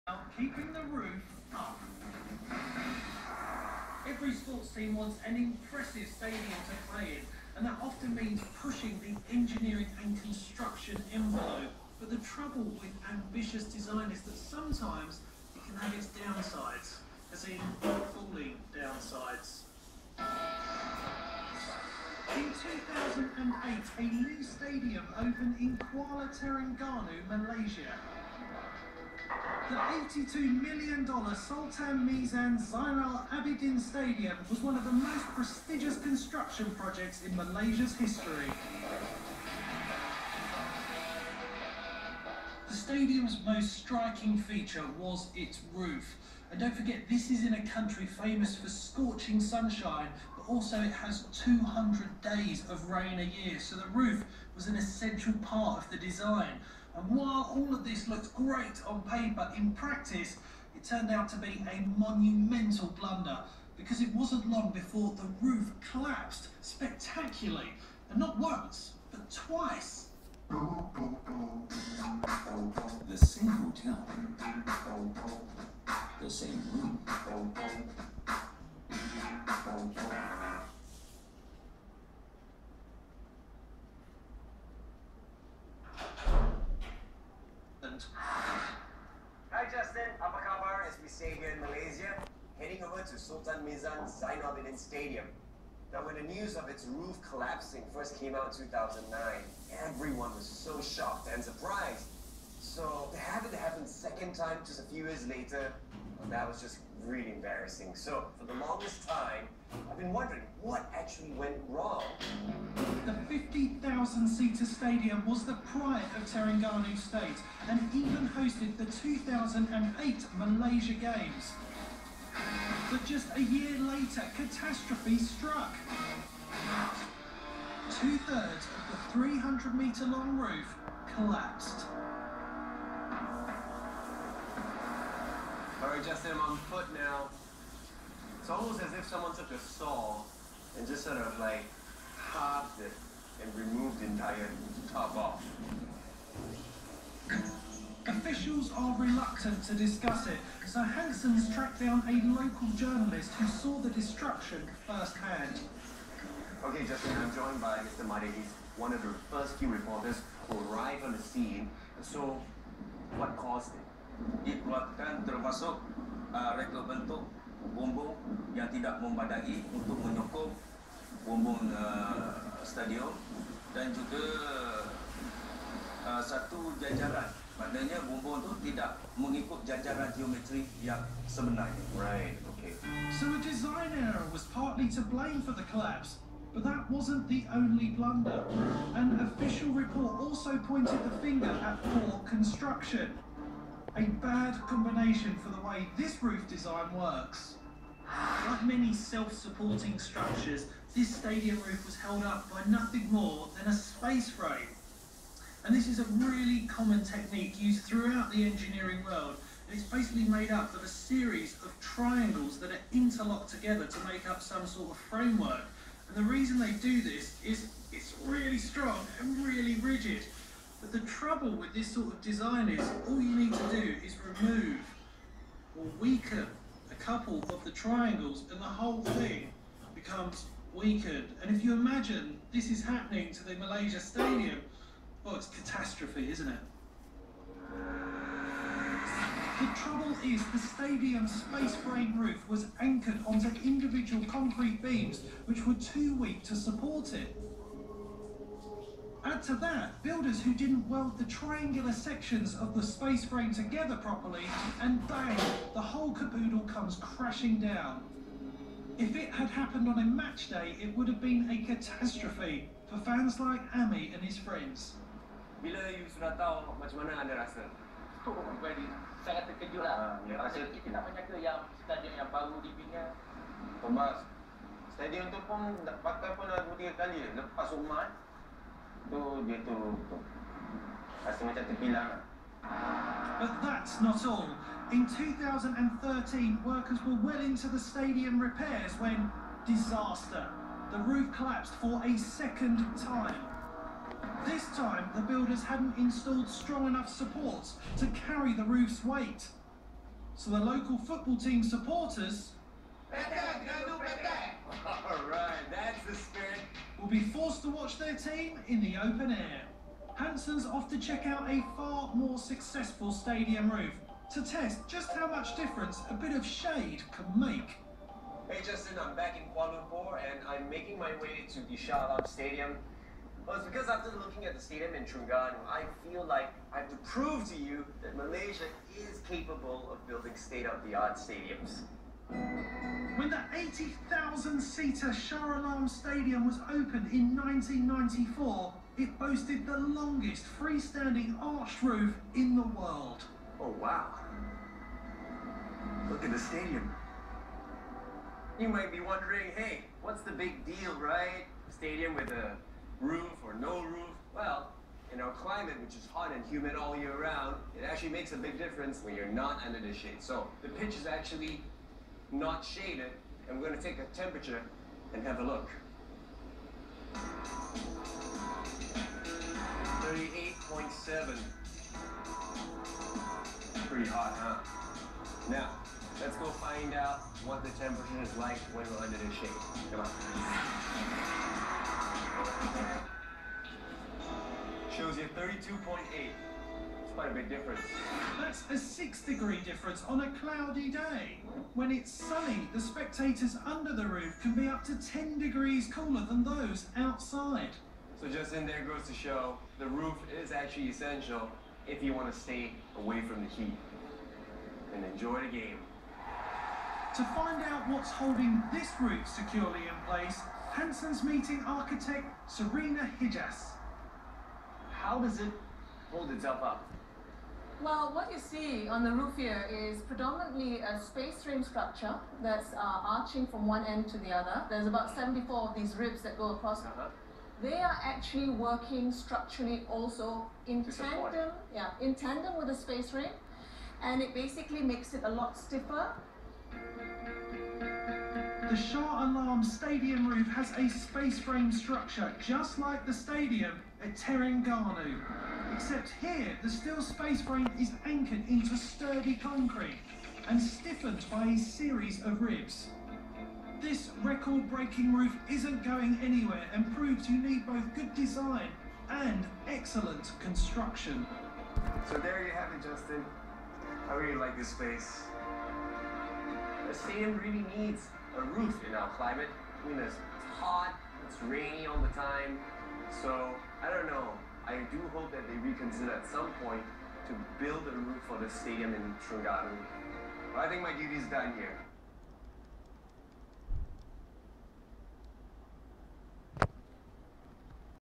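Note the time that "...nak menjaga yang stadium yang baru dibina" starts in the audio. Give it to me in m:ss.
4:30.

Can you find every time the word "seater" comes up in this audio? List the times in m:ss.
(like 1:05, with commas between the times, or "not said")
1:53, 5:33.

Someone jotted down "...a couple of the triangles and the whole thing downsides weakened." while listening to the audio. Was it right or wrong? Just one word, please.
wrong.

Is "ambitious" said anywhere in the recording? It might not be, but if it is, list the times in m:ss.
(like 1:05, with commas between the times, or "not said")
0:13.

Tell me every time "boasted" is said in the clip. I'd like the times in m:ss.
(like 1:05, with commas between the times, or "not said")
5:39.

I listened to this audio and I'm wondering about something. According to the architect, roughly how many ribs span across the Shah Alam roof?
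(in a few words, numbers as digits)
74.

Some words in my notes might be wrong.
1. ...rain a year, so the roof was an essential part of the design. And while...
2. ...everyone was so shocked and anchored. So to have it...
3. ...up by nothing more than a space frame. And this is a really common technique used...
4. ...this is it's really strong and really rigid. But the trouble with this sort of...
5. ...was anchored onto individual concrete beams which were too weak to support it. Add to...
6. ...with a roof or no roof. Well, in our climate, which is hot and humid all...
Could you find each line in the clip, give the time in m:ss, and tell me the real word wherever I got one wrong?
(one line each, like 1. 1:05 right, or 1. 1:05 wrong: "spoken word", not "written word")
1. 0:52 right
2. 1:39 wrong: "surprised", not "anchored"
3. 3:22 right
4. 3:37 right
5. 4:02 right
6. 5:52 right.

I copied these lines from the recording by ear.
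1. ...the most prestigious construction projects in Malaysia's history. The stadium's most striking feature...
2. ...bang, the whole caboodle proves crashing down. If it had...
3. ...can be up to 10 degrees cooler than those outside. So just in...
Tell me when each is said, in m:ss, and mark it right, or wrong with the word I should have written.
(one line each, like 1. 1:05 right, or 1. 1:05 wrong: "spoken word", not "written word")
1. 0:34 right
2. 4:15 wrong: "comes", not "proves"
3. 6:34 right.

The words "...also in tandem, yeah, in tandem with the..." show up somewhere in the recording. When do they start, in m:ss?
7:09.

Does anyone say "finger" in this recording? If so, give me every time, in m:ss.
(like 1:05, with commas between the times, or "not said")
3:11.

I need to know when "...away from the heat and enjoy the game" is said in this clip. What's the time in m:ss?
6:42.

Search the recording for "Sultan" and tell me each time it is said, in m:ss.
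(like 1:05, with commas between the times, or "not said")
0:31, 1:33.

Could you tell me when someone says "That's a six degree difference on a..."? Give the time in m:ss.
6:28.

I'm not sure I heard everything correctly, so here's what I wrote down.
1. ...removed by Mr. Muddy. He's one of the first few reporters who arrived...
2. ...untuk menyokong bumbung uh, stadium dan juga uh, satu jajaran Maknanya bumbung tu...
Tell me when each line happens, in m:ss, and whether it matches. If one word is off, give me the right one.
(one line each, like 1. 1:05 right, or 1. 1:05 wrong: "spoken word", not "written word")
1. 2:37 wrong: "joined", not "removed"
2. 2:49 right.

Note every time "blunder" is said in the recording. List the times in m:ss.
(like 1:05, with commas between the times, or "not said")
1:02, 3:07.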